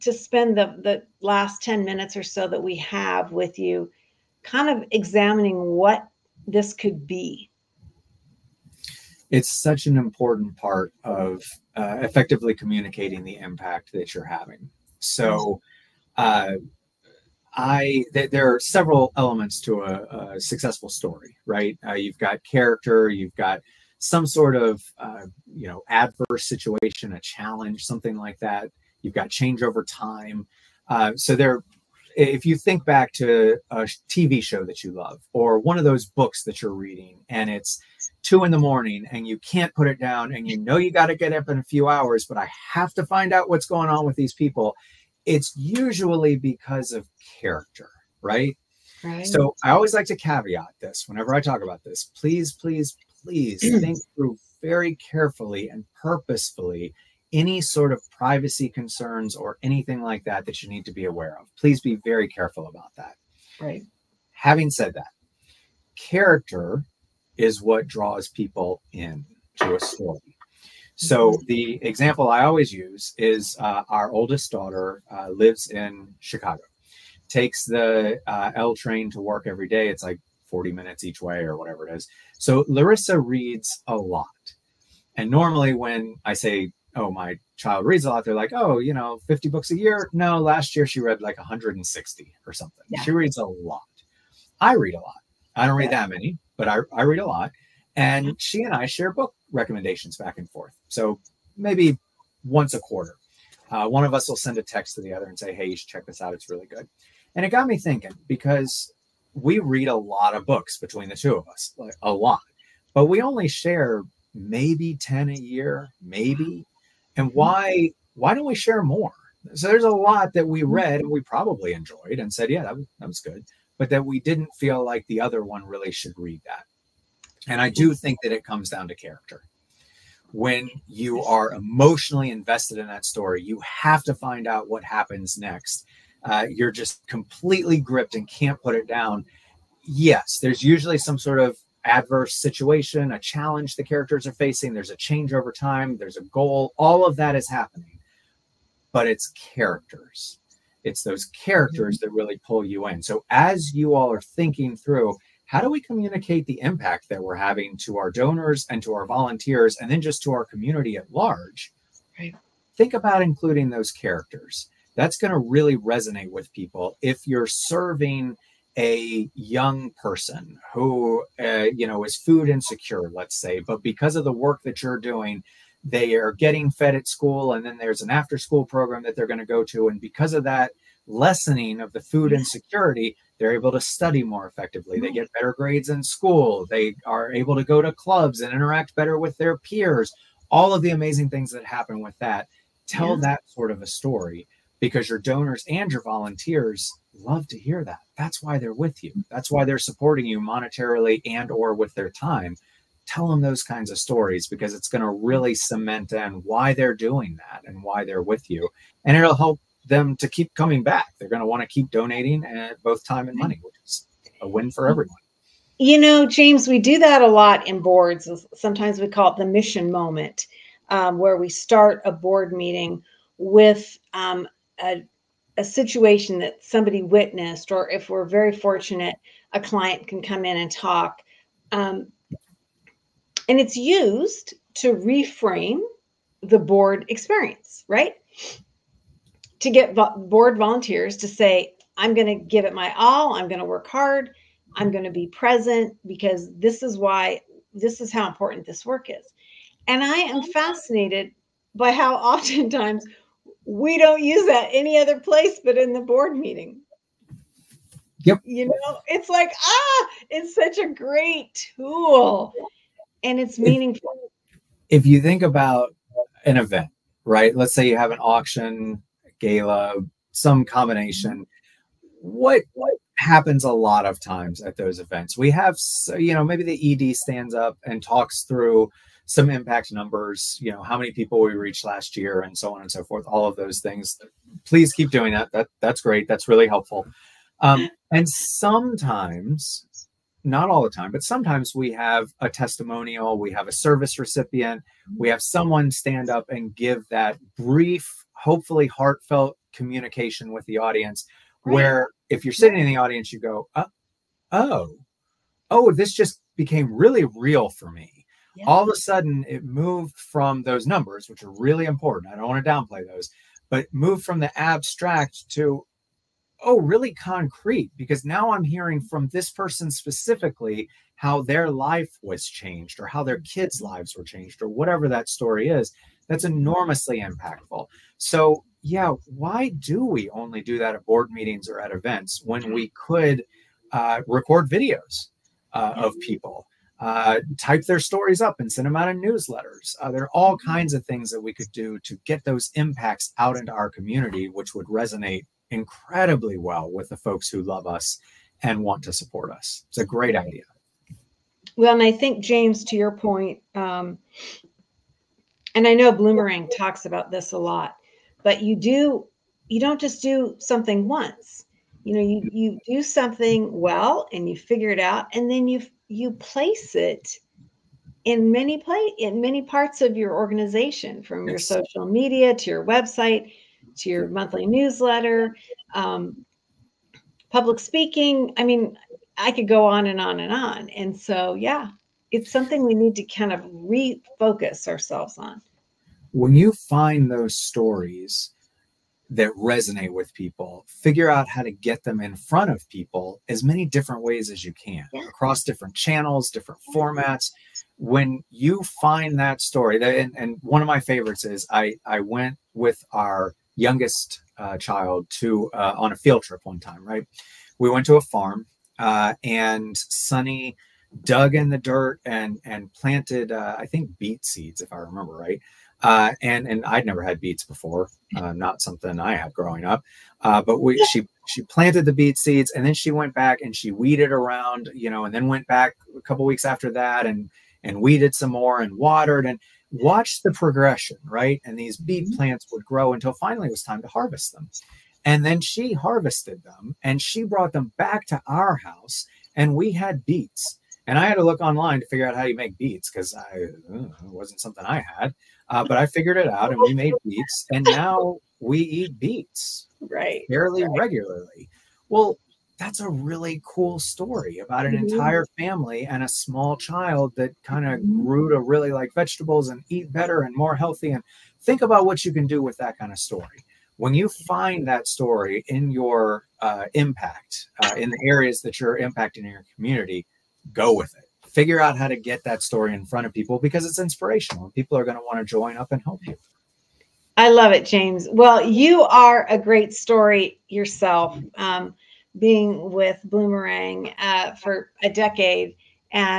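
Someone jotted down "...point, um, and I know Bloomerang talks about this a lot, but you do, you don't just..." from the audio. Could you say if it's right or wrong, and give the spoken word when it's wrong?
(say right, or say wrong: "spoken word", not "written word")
right.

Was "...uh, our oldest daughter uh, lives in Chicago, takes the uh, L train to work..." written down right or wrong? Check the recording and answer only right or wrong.
right.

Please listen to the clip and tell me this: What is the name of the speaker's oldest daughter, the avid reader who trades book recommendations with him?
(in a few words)
Larissa.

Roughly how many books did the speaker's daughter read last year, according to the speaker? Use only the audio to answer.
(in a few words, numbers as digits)
160.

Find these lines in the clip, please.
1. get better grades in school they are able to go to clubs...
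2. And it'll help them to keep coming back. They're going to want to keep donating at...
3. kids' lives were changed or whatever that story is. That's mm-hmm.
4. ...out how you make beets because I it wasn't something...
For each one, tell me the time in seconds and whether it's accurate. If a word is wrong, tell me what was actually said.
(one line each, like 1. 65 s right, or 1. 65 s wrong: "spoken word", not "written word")
1. 185 s right
2. 209 s right
3. 323 s right
4. 442 s right.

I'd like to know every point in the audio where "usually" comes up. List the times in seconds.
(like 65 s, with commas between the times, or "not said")
45 s, 140 s.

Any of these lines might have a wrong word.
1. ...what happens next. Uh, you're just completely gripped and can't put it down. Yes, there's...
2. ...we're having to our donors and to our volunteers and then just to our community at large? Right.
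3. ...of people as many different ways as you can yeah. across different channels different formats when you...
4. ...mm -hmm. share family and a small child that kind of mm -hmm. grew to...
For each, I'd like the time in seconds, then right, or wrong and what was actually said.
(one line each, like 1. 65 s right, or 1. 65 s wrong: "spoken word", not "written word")
1. 134 s right
2. 157 s right
3. 392 s right
4. 454 s wrong: "entire", not "share".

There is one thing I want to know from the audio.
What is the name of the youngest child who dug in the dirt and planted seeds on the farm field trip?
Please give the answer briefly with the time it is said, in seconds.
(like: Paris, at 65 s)
Sunny, at 409 s.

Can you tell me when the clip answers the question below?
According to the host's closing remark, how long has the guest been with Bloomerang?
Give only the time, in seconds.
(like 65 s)
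485 s.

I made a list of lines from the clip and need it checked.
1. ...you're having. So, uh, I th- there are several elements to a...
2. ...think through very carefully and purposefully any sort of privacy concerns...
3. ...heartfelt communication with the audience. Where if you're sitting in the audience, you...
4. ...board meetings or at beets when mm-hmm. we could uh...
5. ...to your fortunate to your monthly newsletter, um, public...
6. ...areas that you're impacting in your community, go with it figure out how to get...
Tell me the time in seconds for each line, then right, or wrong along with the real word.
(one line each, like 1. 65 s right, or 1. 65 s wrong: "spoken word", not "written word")
1. 14 s right
2. 53 s right
3. 298 s right
4. 331 s wrong: "events", not "beets"
5. 372 s wrong: "website", not "fortunate"
6. 468 s right.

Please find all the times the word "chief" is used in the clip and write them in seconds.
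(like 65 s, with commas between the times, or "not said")
not said.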